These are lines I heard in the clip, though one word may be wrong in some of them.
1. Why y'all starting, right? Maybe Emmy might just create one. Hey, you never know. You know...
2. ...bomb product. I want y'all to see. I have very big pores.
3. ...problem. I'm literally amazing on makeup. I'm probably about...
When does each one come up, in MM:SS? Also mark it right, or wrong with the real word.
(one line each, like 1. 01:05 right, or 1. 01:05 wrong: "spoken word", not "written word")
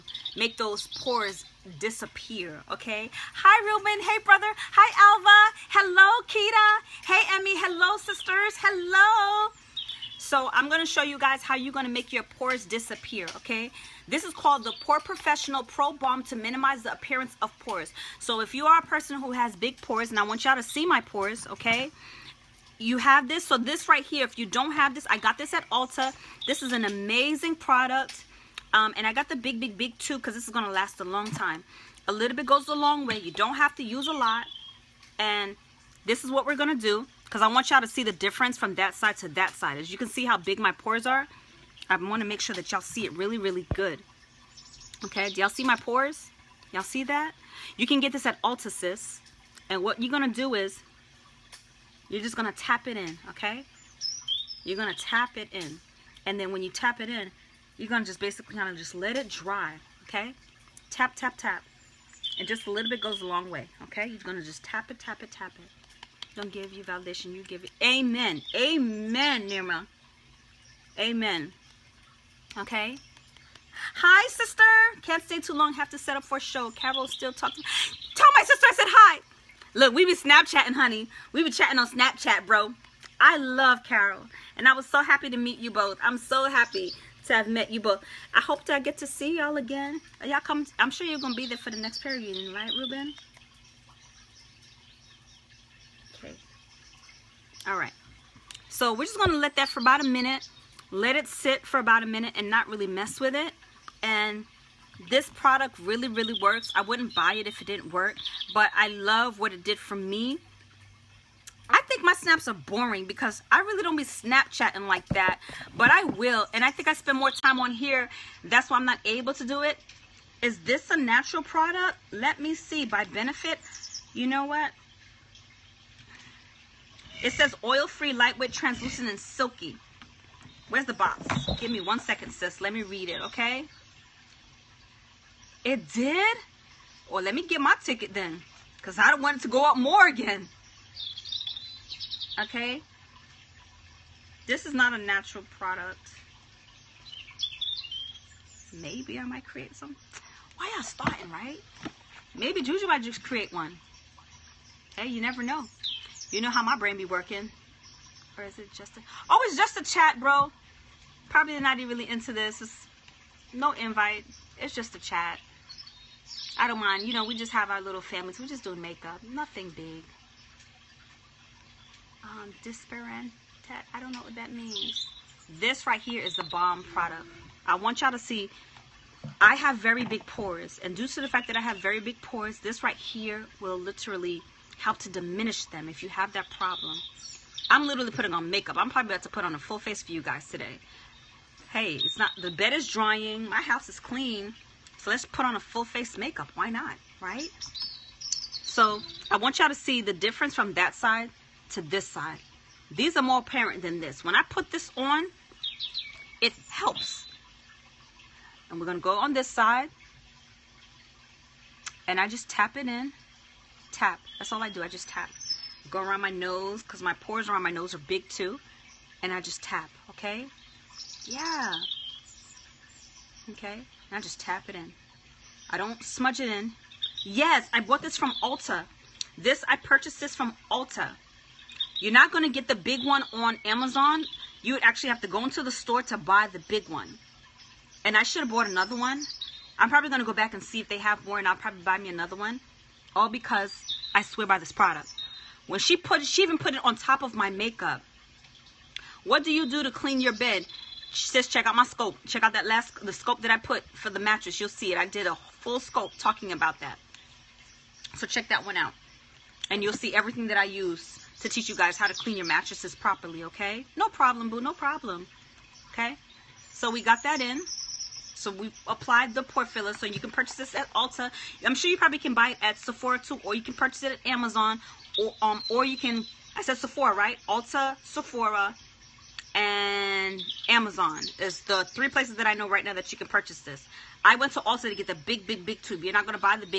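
1. 02:30 wrong: "Juju", not "Emmy"
2. 02:56 right
3. 03:06 wrong: "putting", not "amazing".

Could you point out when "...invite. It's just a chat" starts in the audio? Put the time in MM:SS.
02:43.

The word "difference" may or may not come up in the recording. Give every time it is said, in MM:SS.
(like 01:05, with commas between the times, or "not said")
00:38, 03:20.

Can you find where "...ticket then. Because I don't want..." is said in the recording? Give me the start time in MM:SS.
02:17.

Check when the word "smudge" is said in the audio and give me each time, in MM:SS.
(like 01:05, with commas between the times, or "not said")
03:46.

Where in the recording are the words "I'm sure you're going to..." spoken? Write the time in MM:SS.
01:30.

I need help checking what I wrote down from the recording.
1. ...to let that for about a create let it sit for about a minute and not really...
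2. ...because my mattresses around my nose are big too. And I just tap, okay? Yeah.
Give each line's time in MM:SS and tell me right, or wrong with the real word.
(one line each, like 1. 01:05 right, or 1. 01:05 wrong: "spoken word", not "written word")
1. 01:39 wrong: "minute", not "create"
2. 03:36 wrong: "pores", not "mattresses".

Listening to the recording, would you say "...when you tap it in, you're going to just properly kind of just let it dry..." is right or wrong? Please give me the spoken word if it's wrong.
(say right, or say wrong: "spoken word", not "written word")
wrong: "basically", not "properly".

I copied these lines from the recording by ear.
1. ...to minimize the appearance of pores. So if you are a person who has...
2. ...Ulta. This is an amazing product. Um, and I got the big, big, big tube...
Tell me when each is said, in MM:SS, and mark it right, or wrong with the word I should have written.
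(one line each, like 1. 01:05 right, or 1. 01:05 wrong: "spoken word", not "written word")
1. 00:16 right
2. 00:25 right.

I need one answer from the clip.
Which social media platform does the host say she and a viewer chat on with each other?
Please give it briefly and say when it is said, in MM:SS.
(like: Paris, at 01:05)
Snapchat, at 01:21.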